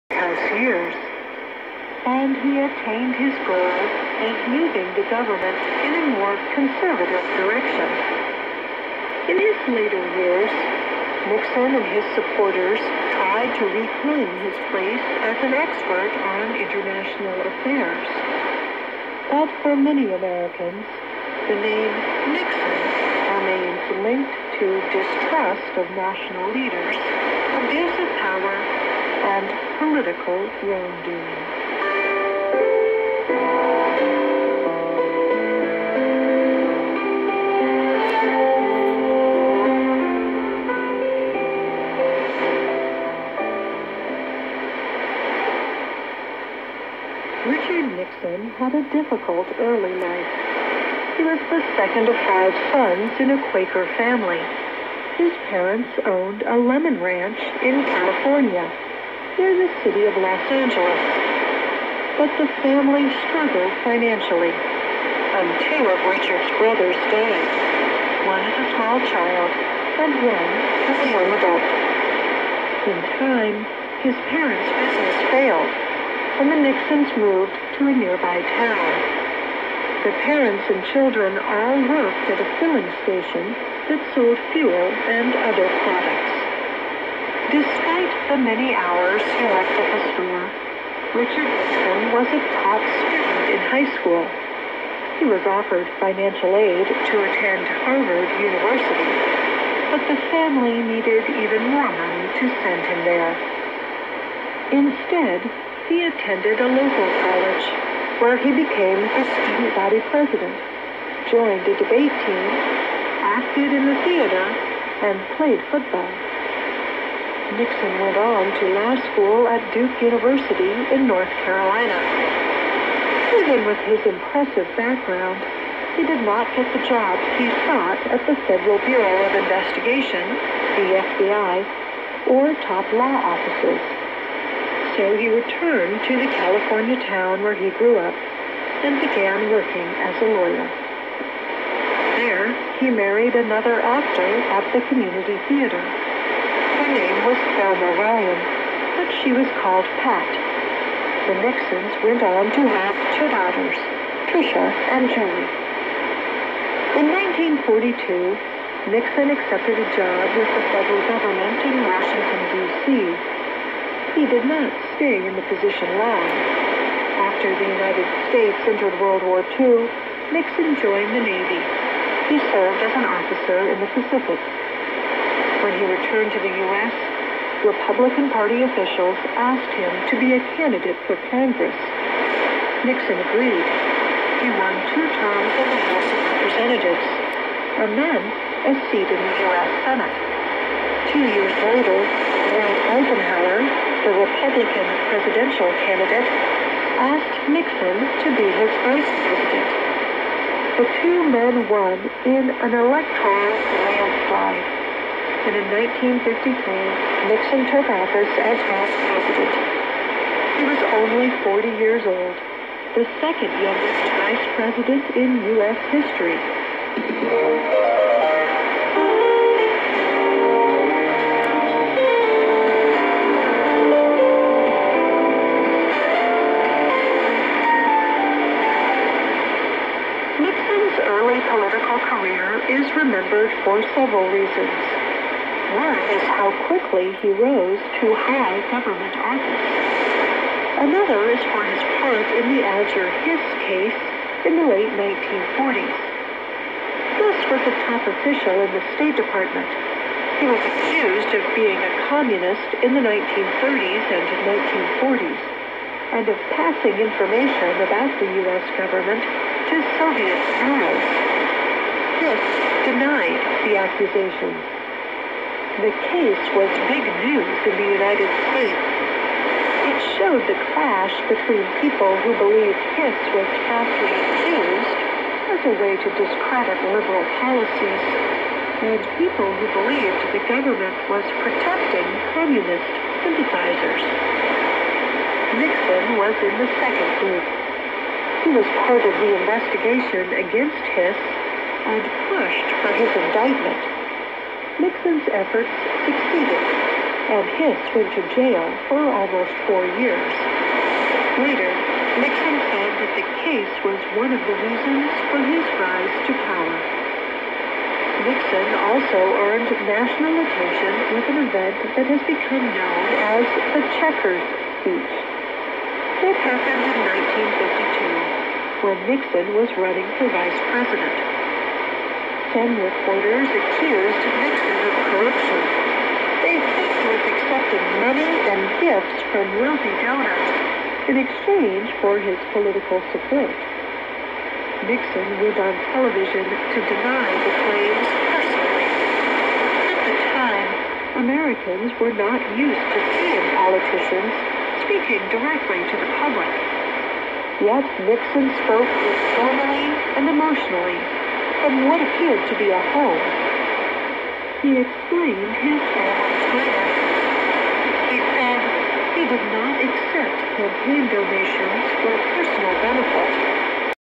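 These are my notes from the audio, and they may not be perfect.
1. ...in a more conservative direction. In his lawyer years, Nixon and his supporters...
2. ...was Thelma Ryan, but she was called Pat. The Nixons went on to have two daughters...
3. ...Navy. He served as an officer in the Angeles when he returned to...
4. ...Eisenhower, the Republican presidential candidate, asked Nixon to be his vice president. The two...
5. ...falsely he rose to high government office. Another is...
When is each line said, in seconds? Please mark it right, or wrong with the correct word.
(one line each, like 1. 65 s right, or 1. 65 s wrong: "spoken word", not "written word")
1. 5 s wrong: "later", not "lawyer"
2. 147 s right
3. 171 s wrong: "Pacific", not "Angeles"
4. 192 s right
5. 236 s wrong: "quickly", not "falsely".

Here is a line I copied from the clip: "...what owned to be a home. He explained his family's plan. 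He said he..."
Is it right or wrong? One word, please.
wrong.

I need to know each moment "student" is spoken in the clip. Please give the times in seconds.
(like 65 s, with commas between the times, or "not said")
92 s, 109 s.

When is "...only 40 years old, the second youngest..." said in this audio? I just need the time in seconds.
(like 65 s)
211 s.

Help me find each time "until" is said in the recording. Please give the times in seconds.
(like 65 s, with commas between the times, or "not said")
64 s.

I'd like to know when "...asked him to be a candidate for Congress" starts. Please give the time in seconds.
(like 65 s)
179 s.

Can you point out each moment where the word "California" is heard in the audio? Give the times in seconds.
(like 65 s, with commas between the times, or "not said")
57 s, 136 s.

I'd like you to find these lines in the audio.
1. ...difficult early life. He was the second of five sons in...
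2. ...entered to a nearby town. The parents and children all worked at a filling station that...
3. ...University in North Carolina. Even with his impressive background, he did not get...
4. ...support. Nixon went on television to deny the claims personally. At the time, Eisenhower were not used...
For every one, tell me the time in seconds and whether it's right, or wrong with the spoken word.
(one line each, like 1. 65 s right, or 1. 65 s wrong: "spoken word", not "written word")
1. 48 s right
2. 77 s wrong: "moved", not "entered"
3. 120 s right
4. 333 s wrong: "Americans", not "Eisenhower".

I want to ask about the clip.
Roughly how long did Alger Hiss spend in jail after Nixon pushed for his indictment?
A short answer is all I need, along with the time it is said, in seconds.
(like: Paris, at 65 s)
Almost 4 years, at 299 s.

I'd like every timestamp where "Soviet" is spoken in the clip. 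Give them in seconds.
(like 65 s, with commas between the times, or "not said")
259 s.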